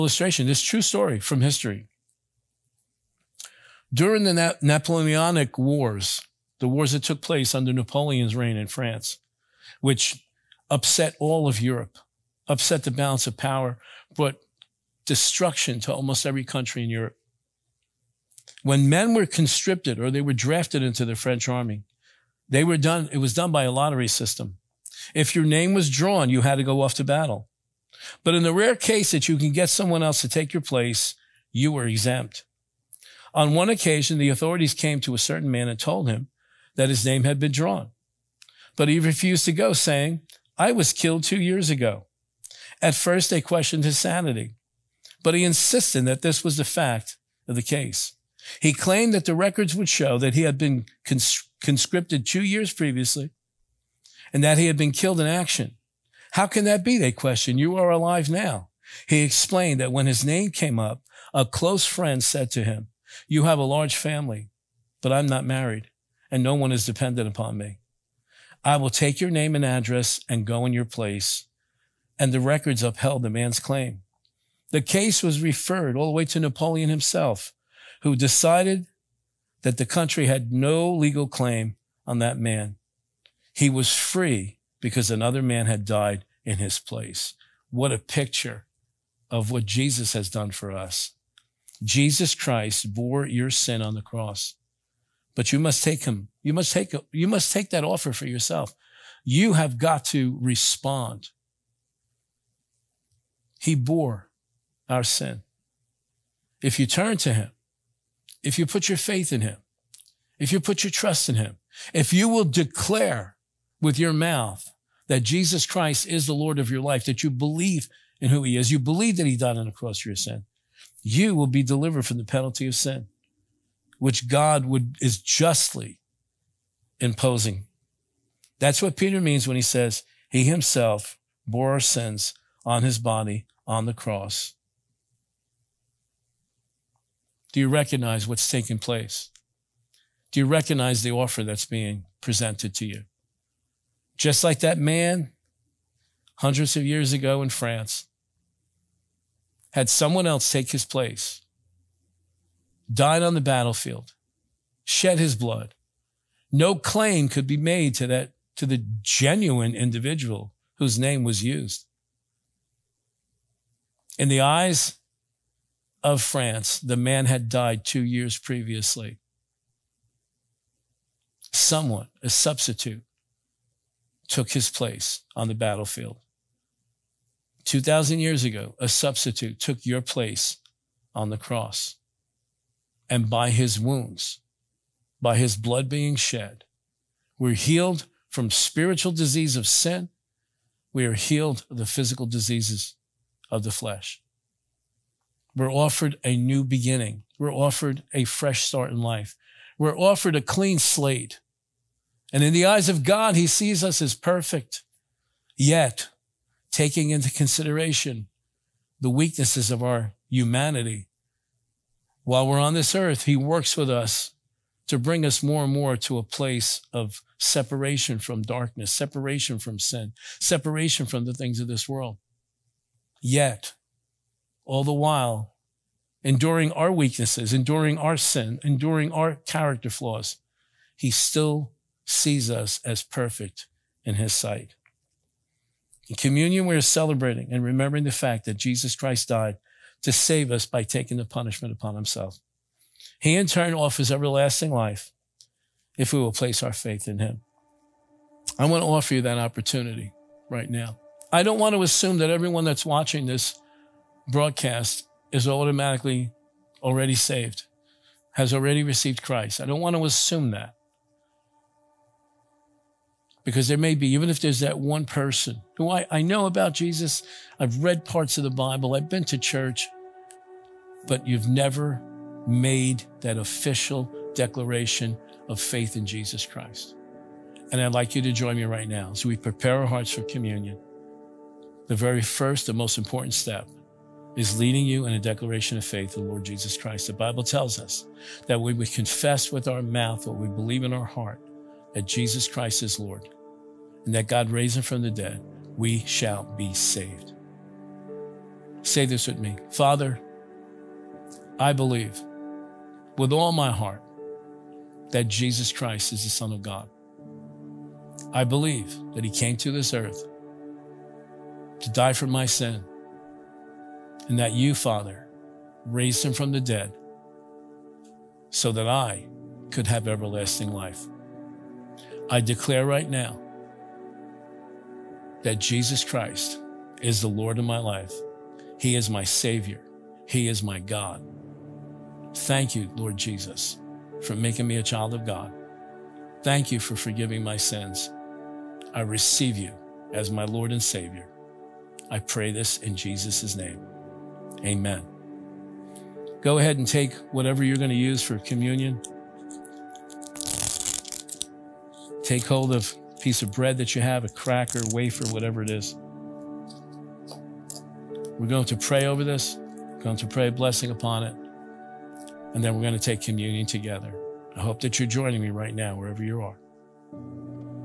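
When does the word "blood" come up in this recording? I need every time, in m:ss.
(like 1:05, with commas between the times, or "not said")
2:35, 3:05.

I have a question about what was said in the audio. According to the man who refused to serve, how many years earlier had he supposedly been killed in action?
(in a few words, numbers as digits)
2.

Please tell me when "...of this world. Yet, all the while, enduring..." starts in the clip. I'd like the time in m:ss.
3:41.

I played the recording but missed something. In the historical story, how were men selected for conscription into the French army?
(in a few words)
lottery system.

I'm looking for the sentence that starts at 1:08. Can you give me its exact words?
I will take your name and address and go in your place.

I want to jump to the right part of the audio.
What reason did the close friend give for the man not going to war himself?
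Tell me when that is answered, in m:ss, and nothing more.
1:03.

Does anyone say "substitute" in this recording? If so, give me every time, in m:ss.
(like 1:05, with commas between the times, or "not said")
2:52, 2:58.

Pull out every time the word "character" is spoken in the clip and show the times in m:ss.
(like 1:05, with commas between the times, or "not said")
3:49.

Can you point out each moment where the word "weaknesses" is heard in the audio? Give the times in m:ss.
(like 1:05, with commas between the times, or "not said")
3:29, 3:46.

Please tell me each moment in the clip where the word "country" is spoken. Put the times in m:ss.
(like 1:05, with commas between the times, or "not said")
0:16, 1:19.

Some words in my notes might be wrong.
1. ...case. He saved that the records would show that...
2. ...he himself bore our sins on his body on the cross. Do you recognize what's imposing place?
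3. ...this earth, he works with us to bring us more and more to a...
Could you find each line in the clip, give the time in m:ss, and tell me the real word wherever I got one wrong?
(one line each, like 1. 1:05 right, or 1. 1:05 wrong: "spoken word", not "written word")
1. 0:47 wrong: "claimed", not "saved"
2. 2:10 wrong: "taking", not "imposing"
3. 3:32 right.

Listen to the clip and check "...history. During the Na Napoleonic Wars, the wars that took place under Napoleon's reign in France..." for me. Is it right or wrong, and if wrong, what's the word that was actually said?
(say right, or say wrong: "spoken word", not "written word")
right.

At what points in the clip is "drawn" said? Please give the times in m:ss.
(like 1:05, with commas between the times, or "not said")
0:25, 0:37.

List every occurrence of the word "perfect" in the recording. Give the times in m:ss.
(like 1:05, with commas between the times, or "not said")
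3:24, 3:53.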